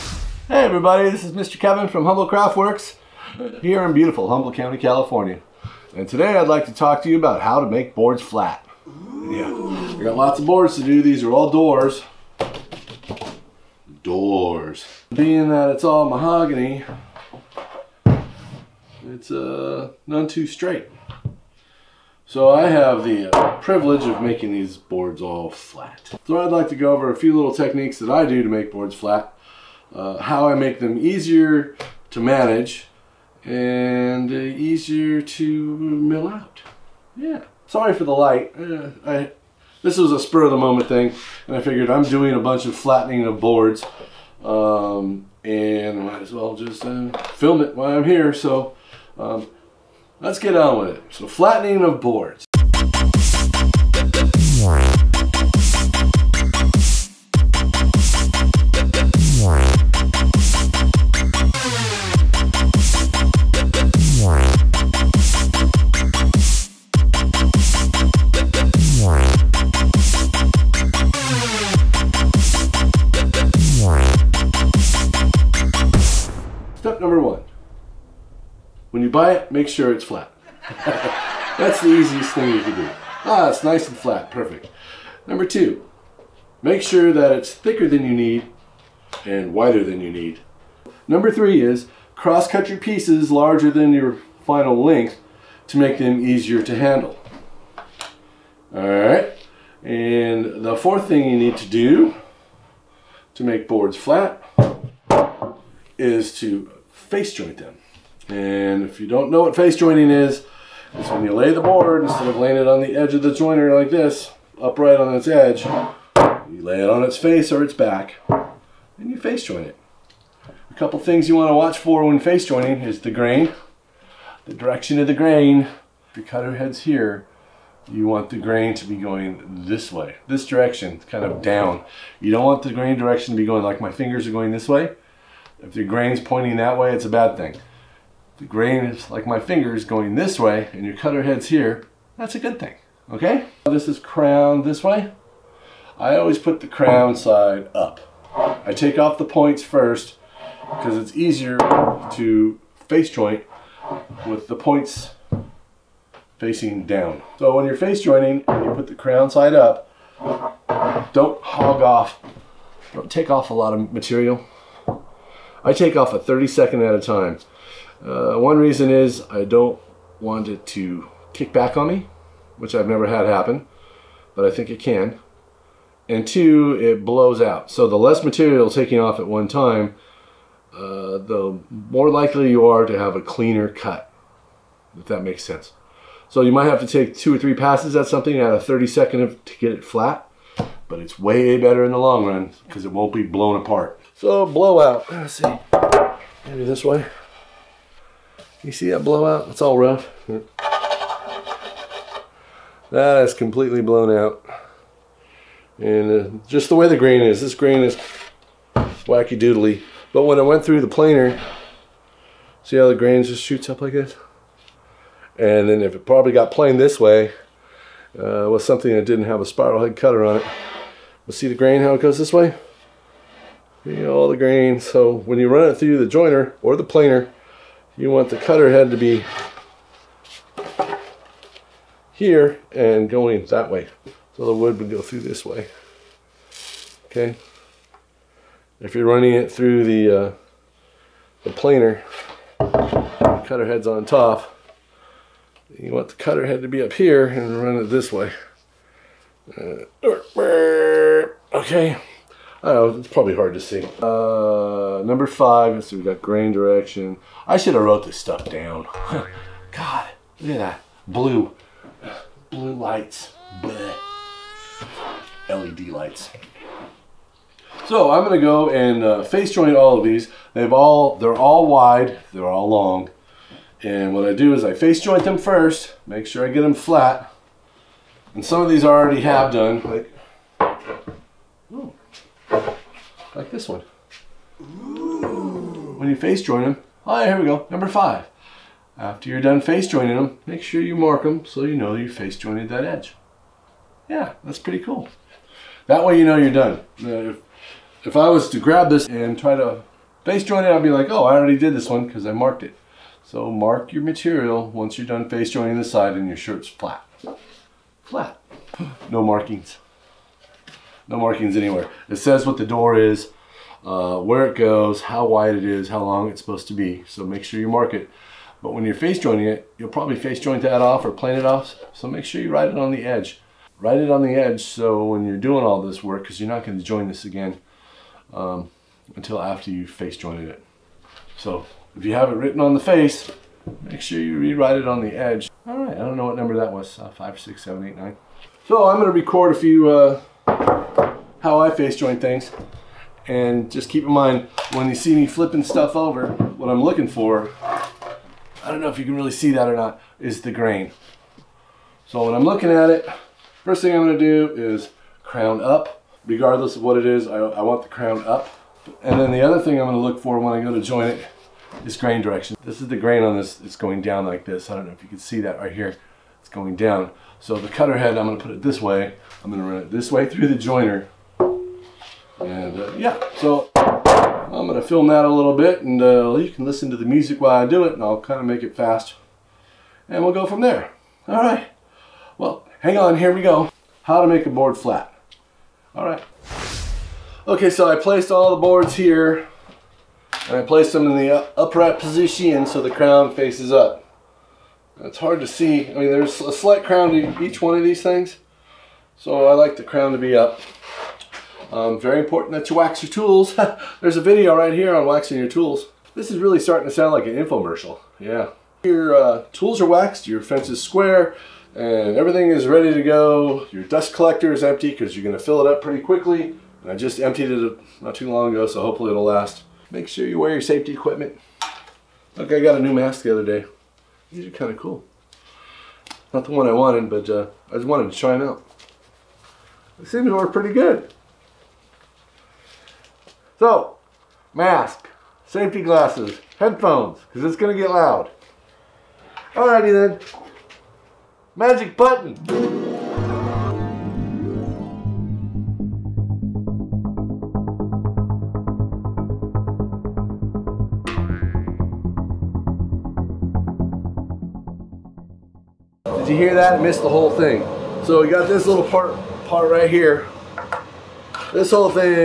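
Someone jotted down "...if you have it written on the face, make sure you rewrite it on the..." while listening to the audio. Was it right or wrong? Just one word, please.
right.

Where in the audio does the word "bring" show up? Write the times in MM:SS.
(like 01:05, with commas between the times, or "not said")
not said.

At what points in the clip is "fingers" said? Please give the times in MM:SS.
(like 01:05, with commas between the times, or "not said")
02:13, 02:19.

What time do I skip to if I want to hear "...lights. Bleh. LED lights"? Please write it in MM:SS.
04:22.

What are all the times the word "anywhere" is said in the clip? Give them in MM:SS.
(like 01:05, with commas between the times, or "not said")
05:11.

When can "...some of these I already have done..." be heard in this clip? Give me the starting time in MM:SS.
04:38.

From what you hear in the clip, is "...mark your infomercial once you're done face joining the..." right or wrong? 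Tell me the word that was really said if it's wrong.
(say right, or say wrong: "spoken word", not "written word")
wrong: "material", not "infomercial".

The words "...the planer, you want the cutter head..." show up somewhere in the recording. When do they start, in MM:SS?
03:46.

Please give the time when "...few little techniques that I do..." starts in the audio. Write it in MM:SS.
00:27.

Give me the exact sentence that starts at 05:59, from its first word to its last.
And then the other thing I'm gonna look for when I go to join it is grain direction.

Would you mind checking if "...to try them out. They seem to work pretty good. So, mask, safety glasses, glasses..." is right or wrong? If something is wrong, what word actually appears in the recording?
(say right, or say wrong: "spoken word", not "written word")
wrong: "headphones", not "glasses".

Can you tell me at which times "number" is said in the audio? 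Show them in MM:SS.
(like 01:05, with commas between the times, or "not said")
01:25, 01:31, 04:15, 04:47, 05:36.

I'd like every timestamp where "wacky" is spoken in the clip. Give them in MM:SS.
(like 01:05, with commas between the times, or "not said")
03:28.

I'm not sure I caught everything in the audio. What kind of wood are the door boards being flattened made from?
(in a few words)
Mahogany.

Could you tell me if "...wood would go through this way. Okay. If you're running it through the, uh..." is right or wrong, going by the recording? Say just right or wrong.
right.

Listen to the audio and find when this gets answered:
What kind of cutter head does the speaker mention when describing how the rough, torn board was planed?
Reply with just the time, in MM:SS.
03:39.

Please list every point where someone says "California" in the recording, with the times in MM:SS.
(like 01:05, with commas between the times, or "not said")
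00:04.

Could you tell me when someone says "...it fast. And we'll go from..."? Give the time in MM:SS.
06:18.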